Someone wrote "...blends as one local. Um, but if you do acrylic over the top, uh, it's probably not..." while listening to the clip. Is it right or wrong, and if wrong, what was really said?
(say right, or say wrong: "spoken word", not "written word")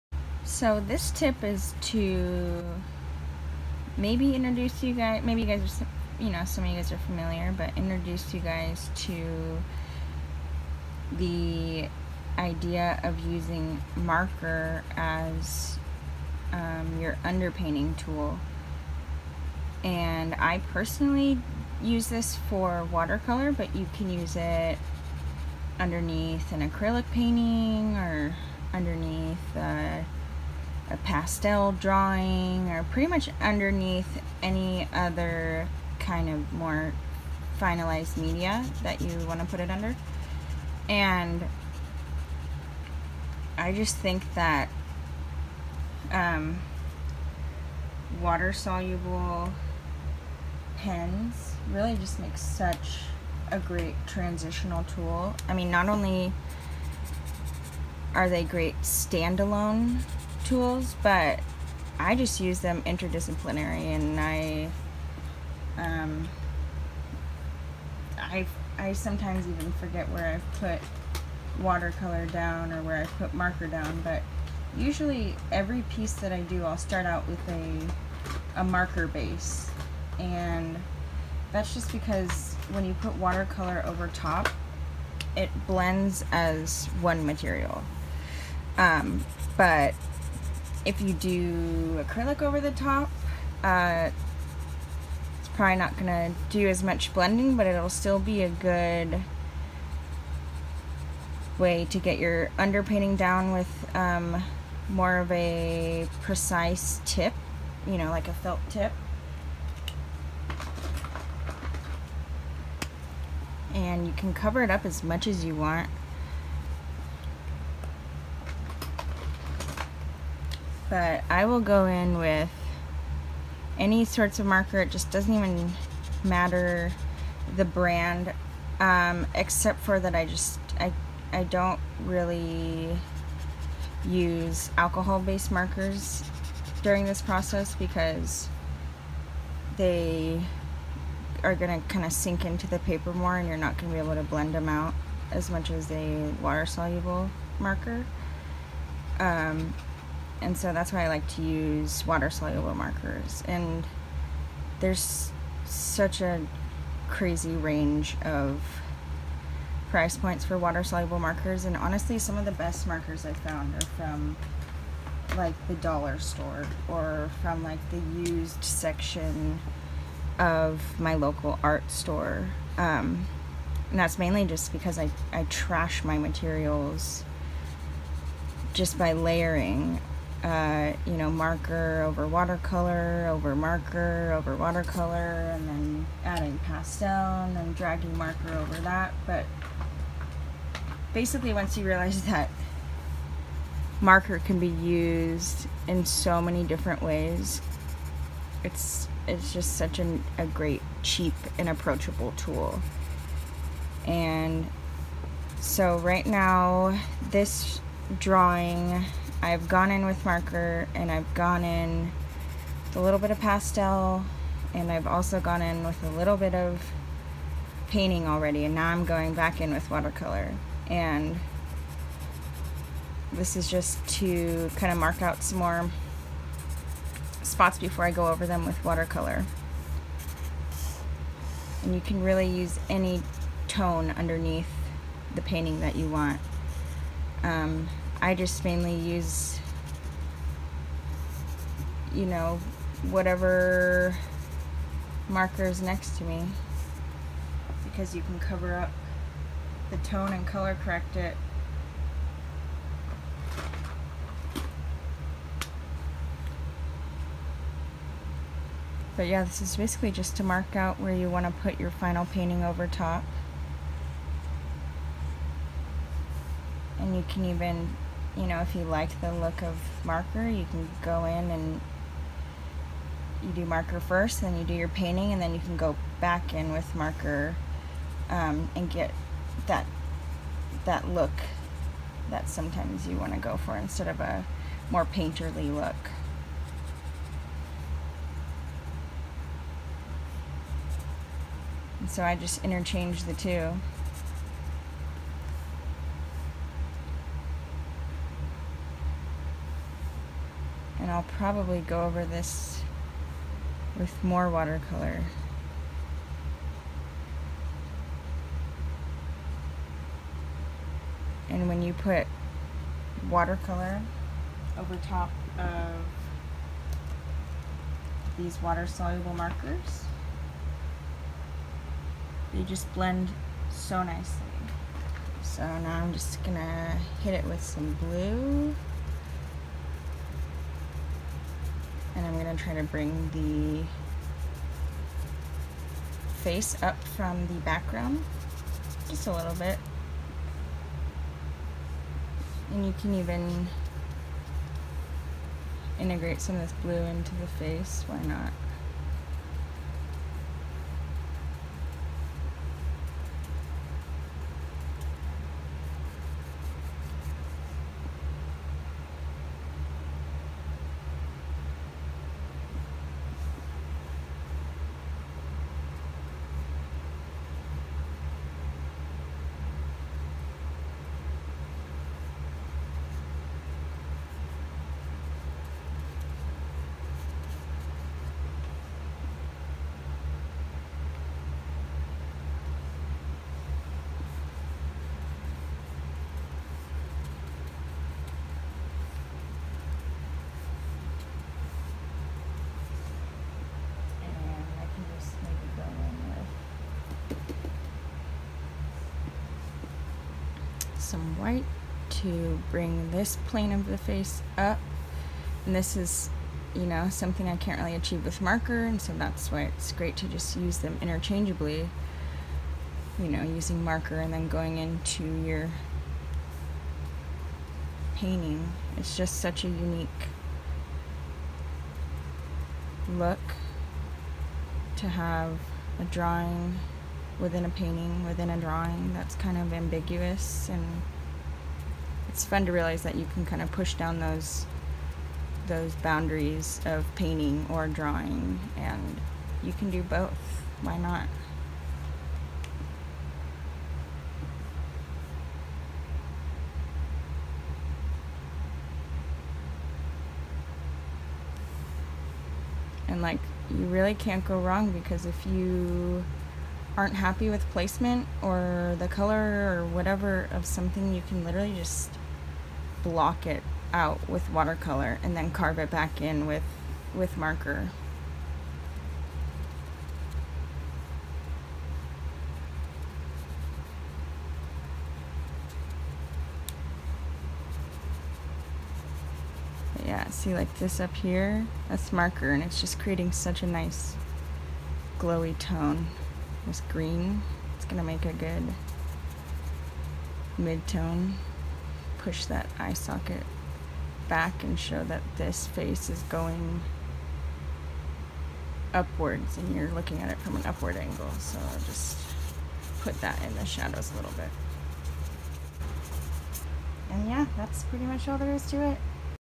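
wrong: "material", not "local".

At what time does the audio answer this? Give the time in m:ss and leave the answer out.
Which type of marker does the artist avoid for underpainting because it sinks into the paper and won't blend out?
2:14.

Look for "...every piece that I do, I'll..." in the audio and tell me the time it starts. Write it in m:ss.
1:15.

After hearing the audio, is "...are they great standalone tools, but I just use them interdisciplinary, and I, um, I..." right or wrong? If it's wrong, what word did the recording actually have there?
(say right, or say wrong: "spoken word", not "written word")
right.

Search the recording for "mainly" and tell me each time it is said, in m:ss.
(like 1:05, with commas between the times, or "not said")
2:54, 3:58.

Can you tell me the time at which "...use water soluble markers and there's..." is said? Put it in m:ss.
2:31.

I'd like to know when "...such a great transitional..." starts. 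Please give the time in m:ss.
0:52.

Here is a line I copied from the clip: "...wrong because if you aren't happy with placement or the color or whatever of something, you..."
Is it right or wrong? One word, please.
right.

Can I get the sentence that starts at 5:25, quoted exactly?
So now I'm just gonna hit it with some blue.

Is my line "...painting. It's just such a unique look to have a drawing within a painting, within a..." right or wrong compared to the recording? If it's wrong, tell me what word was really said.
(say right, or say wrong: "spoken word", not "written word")
right.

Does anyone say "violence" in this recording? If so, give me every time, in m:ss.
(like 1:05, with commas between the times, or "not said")
not said.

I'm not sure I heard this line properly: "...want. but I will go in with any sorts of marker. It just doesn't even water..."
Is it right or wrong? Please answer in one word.
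wrong.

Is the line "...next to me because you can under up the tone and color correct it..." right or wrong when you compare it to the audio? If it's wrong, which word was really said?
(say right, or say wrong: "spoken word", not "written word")
wrong: "cover", not "under".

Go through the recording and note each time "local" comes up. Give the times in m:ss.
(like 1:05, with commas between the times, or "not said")
2:51.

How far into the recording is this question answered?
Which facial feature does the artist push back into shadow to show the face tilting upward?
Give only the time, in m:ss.
8:12.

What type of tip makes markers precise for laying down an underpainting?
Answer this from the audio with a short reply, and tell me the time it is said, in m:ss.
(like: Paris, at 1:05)
Felt tip, at 1:48.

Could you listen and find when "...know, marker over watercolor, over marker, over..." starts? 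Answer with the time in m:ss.
3:01.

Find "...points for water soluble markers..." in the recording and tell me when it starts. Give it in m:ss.
2:40.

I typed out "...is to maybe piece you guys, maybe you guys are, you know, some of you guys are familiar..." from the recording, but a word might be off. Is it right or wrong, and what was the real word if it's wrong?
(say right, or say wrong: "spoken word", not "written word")
wrong: "introduce", not "piece".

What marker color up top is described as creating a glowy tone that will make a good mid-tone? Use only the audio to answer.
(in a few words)
Green.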